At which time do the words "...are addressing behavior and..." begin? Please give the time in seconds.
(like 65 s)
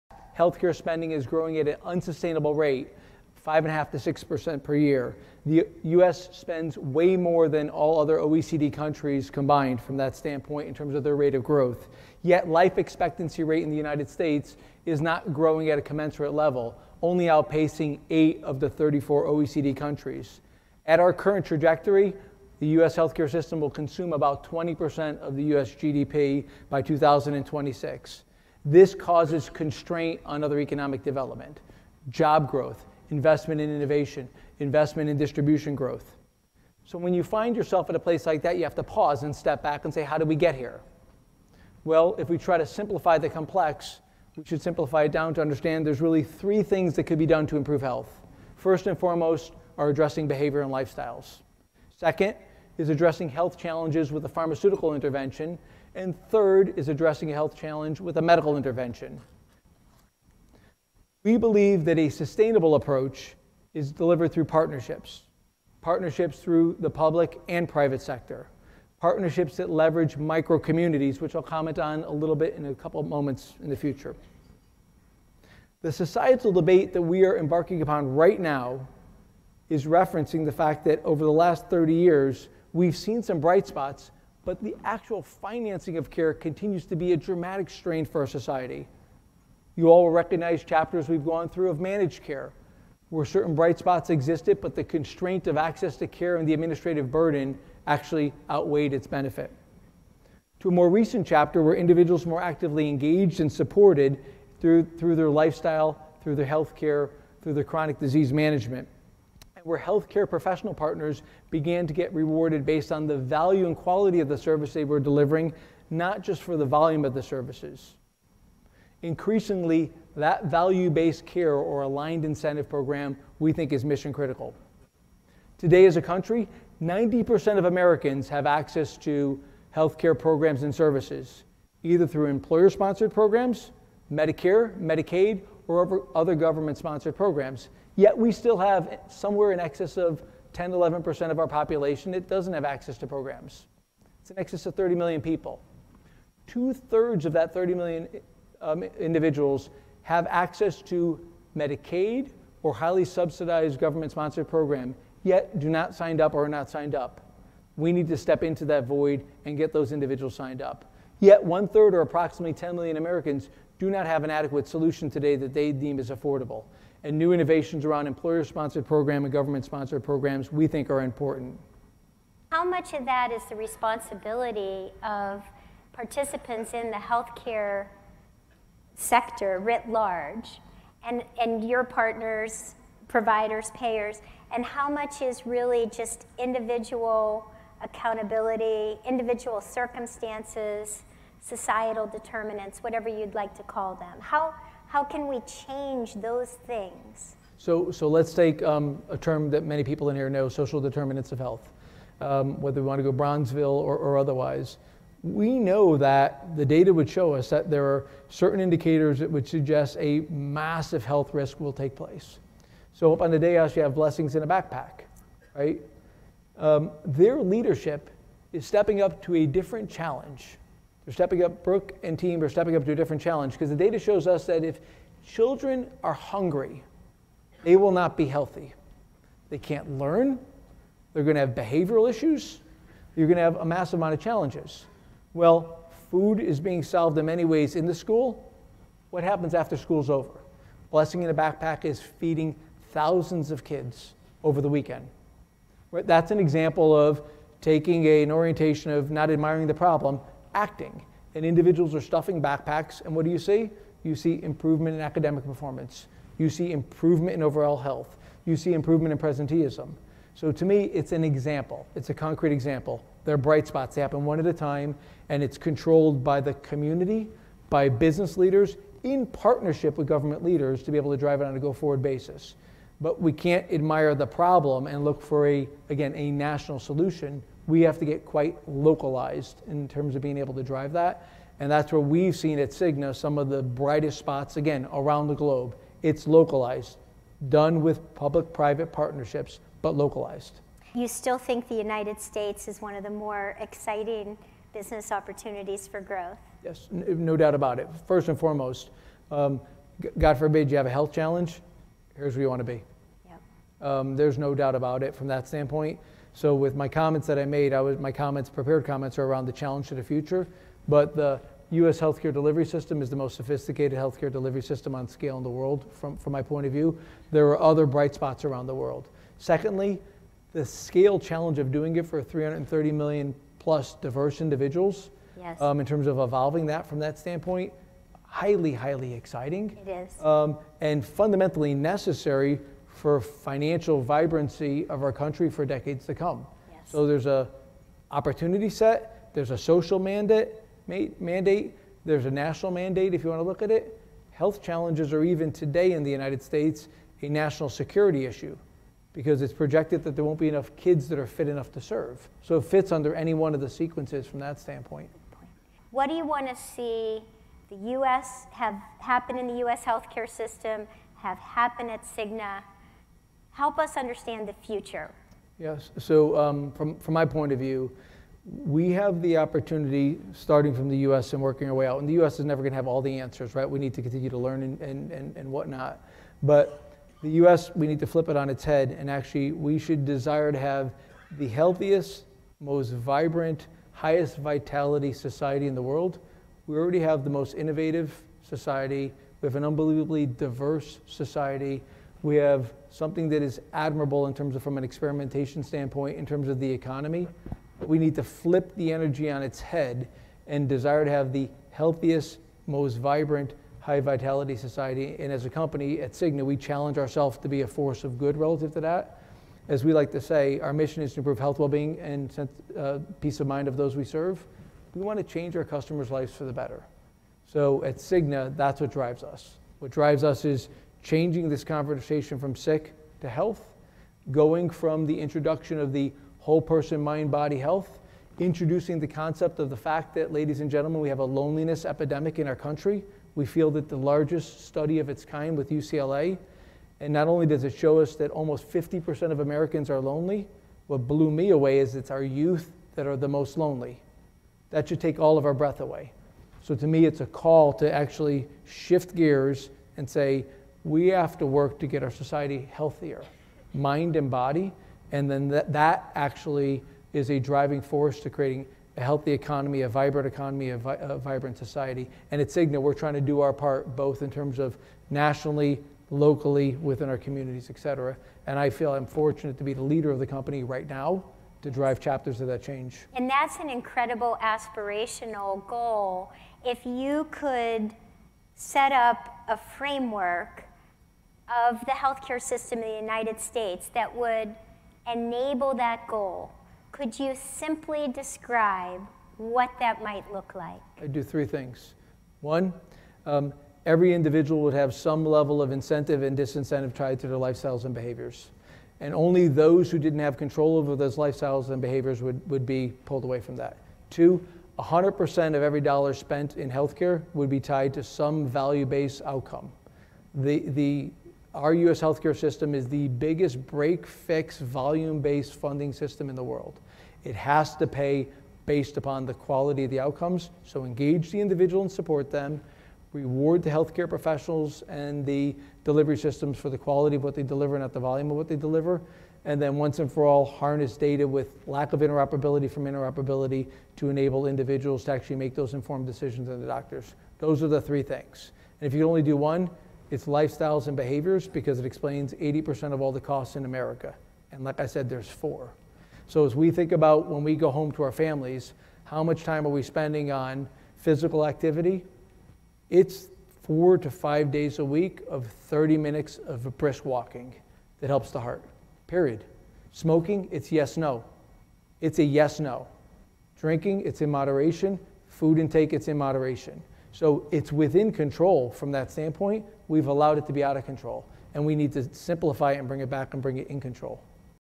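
49 s.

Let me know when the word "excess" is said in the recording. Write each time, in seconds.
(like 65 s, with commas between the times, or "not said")
139 s, 144 s.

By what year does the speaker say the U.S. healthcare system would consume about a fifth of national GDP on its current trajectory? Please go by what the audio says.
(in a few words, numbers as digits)
2026.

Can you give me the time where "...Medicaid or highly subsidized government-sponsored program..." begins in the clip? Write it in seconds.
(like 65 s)
151 s.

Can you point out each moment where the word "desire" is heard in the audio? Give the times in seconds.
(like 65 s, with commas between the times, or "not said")
380 s, 400 s.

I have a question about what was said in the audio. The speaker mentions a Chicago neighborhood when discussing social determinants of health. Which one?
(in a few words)
Bronzeville.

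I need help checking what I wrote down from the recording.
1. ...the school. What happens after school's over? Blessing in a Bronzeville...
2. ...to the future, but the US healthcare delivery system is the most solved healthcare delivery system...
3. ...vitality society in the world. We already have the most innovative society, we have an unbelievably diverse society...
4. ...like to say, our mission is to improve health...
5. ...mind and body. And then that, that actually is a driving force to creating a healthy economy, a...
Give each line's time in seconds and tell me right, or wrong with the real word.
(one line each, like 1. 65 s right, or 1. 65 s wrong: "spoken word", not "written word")
1. 237 s wrong: "Backpack", not "Bronzeville"
2. 309 s wrong: "sophisticated", not "solved"
3. 384 s right
4. 409 s right
5. 453 s right.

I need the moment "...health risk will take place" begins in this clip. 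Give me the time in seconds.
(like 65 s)
211 s.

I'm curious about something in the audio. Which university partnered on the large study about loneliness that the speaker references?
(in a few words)
UCLA.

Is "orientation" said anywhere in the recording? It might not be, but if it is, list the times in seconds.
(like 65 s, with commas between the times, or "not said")
248 s.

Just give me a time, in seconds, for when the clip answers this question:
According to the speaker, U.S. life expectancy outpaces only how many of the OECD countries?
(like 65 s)
18 s.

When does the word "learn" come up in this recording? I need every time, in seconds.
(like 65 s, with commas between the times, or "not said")
229 s, 374 s.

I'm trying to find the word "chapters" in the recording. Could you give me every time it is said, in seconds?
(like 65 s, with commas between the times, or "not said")
90 s, 101 s, 471 s.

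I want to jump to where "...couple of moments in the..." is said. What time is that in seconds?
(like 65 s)
72 s.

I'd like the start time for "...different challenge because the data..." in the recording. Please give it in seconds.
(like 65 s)
222 s.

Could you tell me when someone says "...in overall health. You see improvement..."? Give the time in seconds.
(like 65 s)
257 s.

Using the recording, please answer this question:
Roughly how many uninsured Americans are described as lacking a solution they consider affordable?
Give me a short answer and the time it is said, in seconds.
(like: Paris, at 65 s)
10 million, at 162 s.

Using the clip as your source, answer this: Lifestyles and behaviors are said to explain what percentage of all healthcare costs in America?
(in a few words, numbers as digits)
80%.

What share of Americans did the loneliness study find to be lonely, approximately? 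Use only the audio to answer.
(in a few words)
50%.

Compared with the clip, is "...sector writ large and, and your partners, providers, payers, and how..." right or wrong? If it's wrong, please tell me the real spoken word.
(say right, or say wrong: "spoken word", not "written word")
right.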